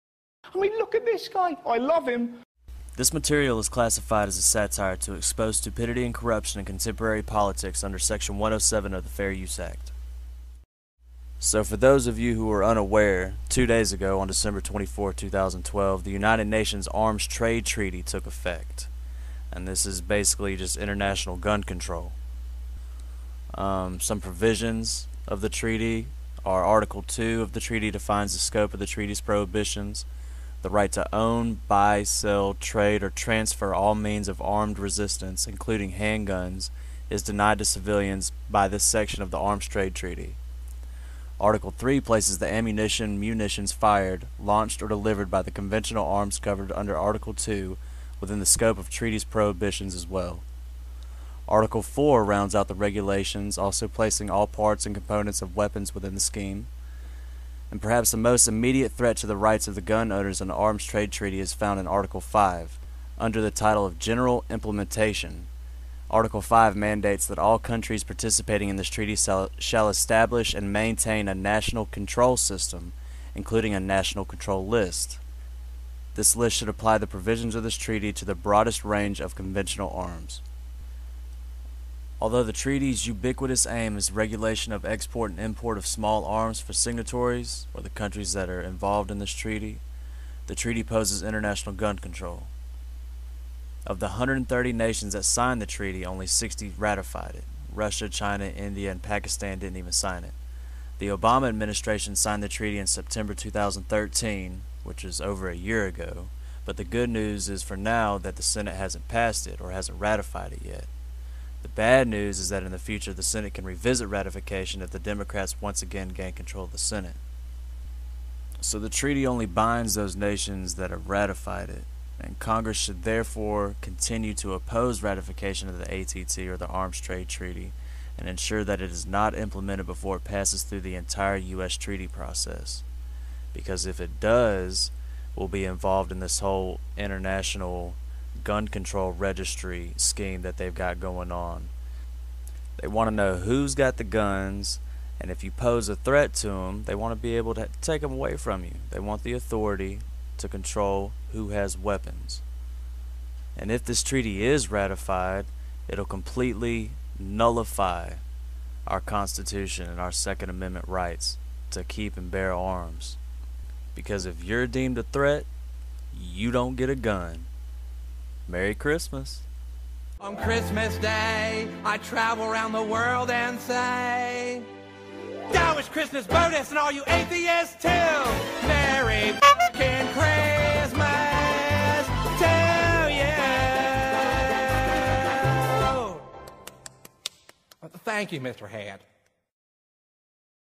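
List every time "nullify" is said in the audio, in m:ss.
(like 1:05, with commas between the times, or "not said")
2:37.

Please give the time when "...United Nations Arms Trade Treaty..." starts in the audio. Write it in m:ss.
0:16.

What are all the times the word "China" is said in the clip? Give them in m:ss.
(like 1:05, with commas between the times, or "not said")
1:38.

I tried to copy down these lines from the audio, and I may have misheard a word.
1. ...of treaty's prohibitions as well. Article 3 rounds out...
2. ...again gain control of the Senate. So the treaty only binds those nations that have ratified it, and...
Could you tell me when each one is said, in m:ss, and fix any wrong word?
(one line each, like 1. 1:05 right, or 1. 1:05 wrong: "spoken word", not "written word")
1. 0:48 wrong: "4", not "3"
2. 1:55 right.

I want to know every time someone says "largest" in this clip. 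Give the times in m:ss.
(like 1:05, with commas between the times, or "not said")
not said.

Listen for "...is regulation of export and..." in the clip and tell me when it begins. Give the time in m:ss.
1:23.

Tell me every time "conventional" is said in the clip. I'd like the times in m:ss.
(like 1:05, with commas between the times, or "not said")
0:45, 1:19.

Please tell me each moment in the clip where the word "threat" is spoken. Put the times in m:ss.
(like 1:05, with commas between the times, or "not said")
0:58, 2:25, 2:45.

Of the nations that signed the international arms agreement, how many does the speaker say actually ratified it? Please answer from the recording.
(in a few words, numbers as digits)
60.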